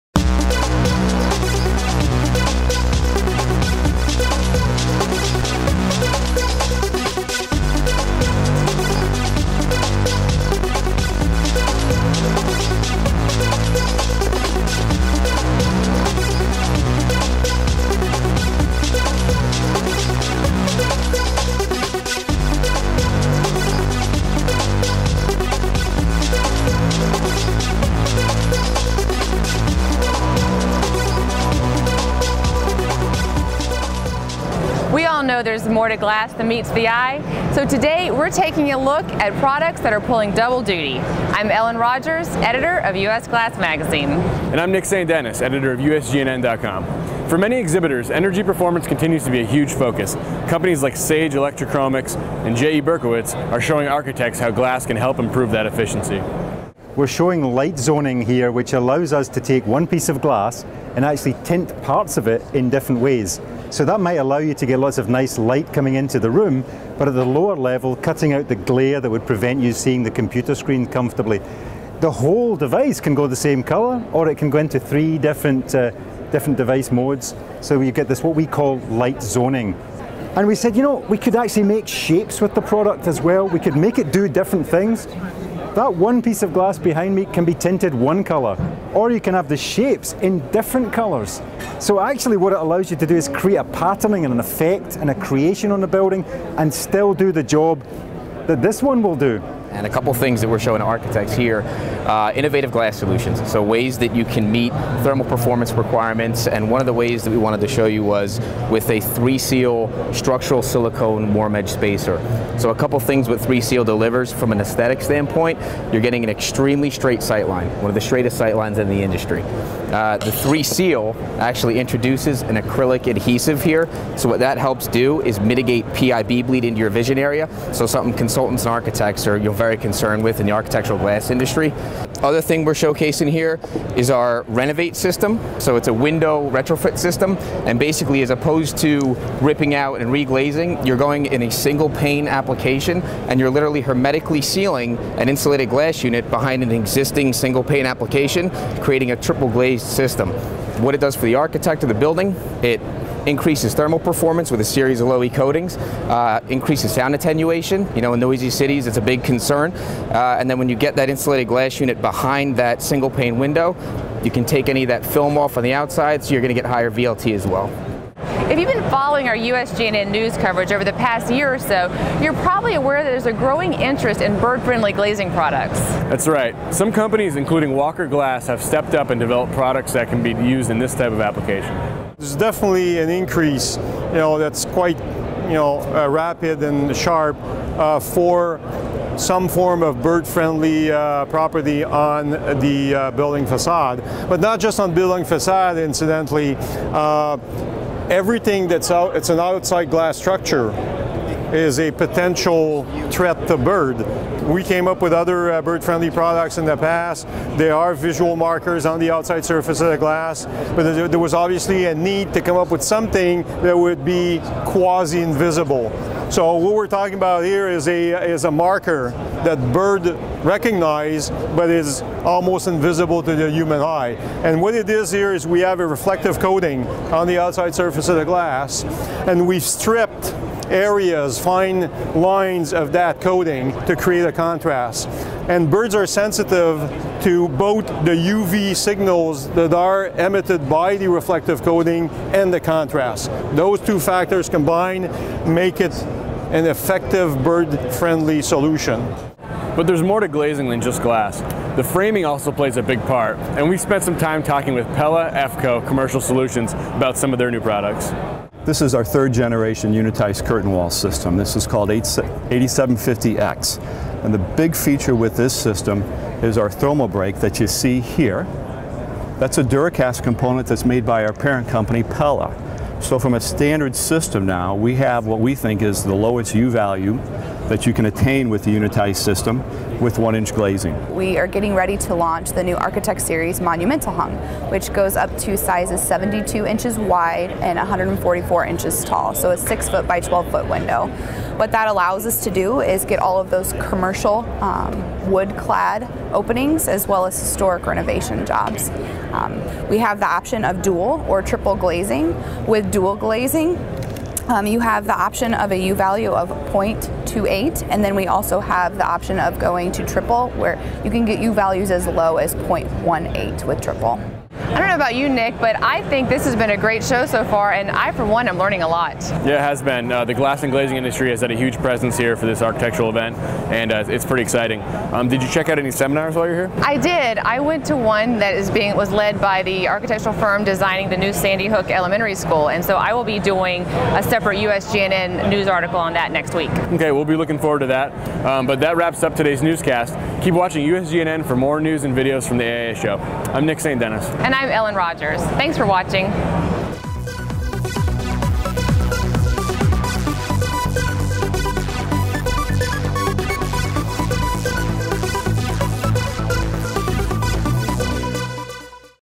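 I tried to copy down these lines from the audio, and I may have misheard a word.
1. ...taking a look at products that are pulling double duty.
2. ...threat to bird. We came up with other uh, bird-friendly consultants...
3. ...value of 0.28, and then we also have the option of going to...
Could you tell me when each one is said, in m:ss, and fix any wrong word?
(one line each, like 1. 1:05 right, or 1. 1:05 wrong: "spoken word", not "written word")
1. 0:38 right
2. 3:23 wrong: "products", not "consultants"
3. 5:05 right.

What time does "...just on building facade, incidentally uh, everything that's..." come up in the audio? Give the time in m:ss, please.
3:14.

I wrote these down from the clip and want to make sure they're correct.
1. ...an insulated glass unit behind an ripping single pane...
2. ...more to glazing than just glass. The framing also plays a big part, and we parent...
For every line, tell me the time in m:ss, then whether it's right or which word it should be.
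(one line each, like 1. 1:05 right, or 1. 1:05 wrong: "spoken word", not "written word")
1. 2:25 wrong: "existing", not "ripping"
2. 4:10 wrong: "spent", not "parent".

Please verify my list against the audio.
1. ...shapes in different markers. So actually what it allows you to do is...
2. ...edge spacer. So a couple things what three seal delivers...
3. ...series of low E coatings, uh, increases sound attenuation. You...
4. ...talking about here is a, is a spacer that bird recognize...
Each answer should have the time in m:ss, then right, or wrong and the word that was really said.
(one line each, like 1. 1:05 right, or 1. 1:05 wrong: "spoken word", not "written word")
1. 1:29 wrong: "colours", not "markers"
2. 1:51 right
3. 2:34 right
4. 3:36 wrong: "marker", not "spacer".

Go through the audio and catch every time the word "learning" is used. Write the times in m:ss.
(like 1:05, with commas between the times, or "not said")
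5:18.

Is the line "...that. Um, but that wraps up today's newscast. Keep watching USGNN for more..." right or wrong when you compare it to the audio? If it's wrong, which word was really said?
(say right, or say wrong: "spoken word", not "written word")
right.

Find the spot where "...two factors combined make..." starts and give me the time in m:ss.
4:03.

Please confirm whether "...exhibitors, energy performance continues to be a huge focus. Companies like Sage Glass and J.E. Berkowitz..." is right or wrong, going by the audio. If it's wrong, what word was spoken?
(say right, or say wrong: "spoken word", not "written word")
wrong: "Electrochromics", not "Glass".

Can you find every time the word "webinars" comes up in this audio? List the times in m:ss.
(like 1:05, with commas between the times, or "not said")
not said.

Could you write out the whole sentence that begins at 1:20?
And we said, you know, we could actually make shapes with the product as well.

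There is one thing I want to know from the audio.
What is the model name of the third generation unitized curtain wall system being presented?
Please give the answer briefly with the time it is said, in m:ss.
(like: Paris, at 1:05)
8750X, at 4:21.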